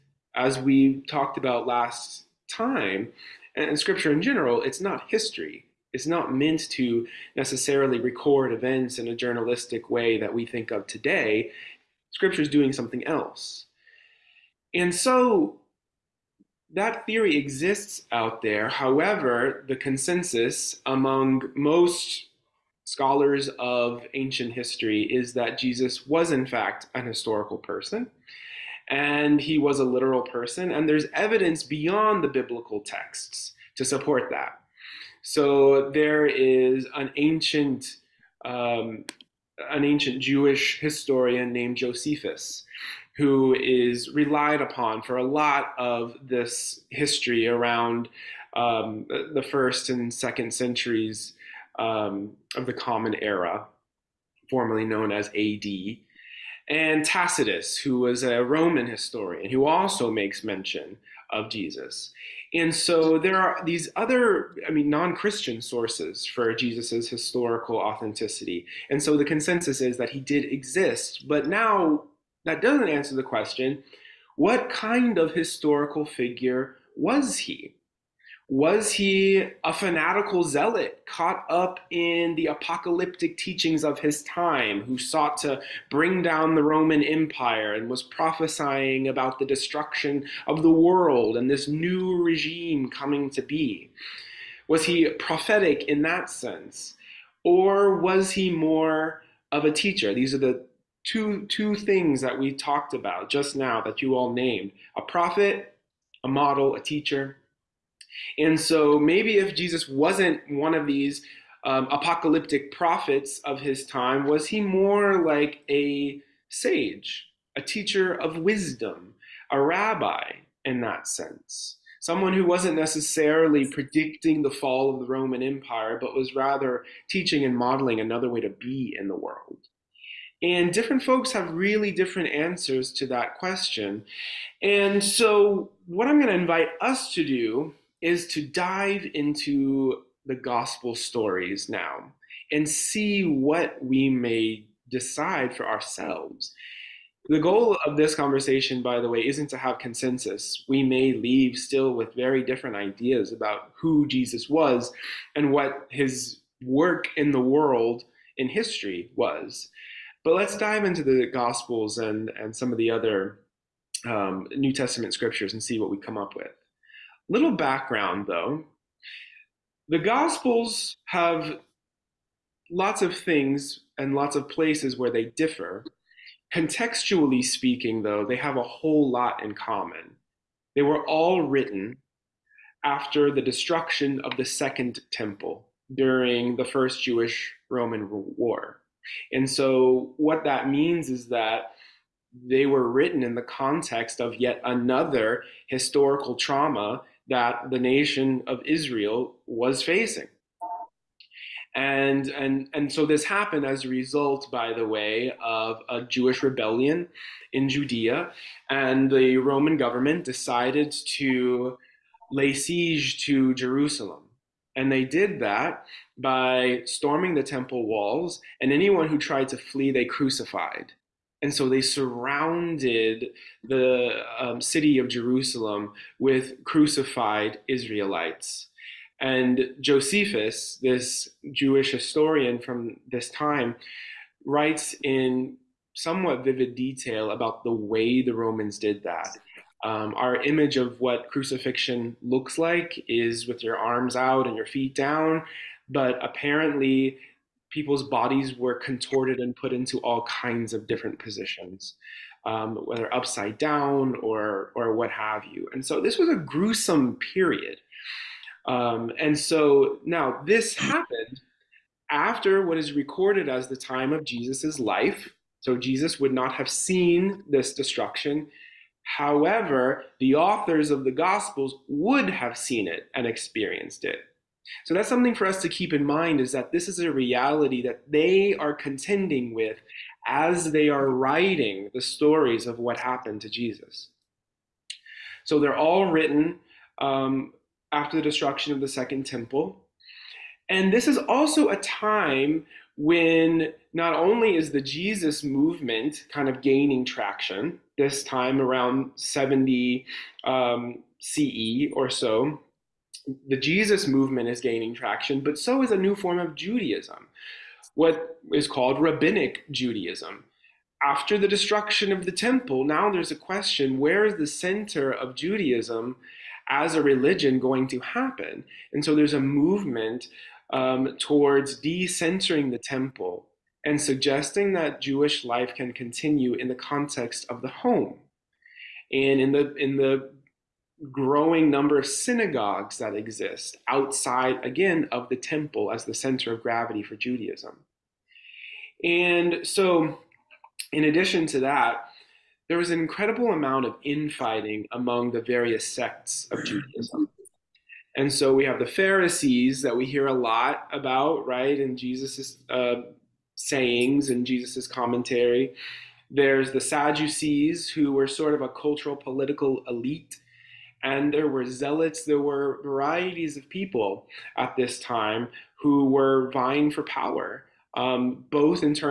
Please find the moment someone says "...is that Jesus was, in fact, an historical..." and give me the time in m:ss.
0:25.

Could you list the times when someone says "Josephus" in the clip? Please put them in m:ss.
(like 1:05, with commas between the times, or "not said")
0:41, 3:49.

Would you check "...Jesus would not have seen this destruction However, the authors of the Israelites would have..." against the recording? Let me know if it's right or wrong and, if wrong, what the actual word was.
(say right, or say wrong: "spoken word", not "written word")
wrong: "Gospels", not "Israelites".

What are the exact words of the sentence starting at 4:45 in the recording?
So they're all written um, after the destruction of the Second Temple.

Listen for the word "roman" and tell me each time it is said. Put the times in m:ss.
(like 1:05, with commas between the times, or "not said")
0:58, 1:26, 2:05, 3:07, 3:29, 3:58.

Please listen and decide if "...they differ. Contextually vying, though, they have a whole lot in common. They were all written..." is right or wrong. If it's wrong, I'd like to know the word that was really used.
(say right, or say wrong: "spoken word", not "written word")
wrong: "speaking", not "vying".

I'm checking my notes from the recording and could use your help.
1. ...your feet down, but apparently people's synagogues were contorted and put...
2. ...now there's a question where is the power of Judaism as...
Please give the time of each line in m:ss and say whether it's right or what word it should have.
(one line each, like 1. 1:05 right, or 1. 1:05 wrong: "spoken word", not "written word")
1. 4:04 wrong: "bodies", not "synagogues"
2. 5:12 wrong: "center", not "power".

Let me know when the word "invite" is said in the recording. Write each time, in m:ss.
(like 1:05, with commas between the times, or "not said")
2:16.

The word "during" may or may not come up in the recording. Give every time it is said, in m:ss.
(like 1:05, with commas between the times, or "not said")
3:05.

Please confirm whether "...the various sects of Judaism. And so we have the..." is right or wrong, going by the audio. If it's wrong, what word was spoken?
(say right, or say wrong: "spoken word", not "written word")
right.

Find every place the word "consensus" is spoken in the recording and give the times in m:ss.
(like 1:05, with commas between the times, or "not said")
0:19, 1:09, 2:29.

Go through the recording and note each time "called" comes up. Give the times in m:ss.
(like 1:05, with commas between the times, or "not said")
5:08.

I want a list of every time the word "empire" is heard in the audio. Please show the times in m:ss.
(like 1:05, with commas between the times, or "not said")
1:27, 2:05.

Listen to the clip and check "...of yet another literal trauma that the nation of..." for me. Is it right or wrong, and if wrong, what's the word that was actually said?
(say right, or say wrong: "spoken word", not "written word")
wrong: "historical", not "literal".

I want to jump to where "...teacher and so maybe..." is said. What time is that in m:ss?
1:46.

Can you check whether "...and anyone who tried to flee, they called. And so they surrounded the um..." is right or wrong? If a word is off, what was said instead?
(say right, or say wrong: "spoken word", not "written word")
wrong: "crucified", not "called".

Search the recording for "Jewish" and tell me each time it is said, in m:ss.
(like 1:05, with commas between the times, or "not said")
0:40, 3:07, 3:26, 3:51, 5:24.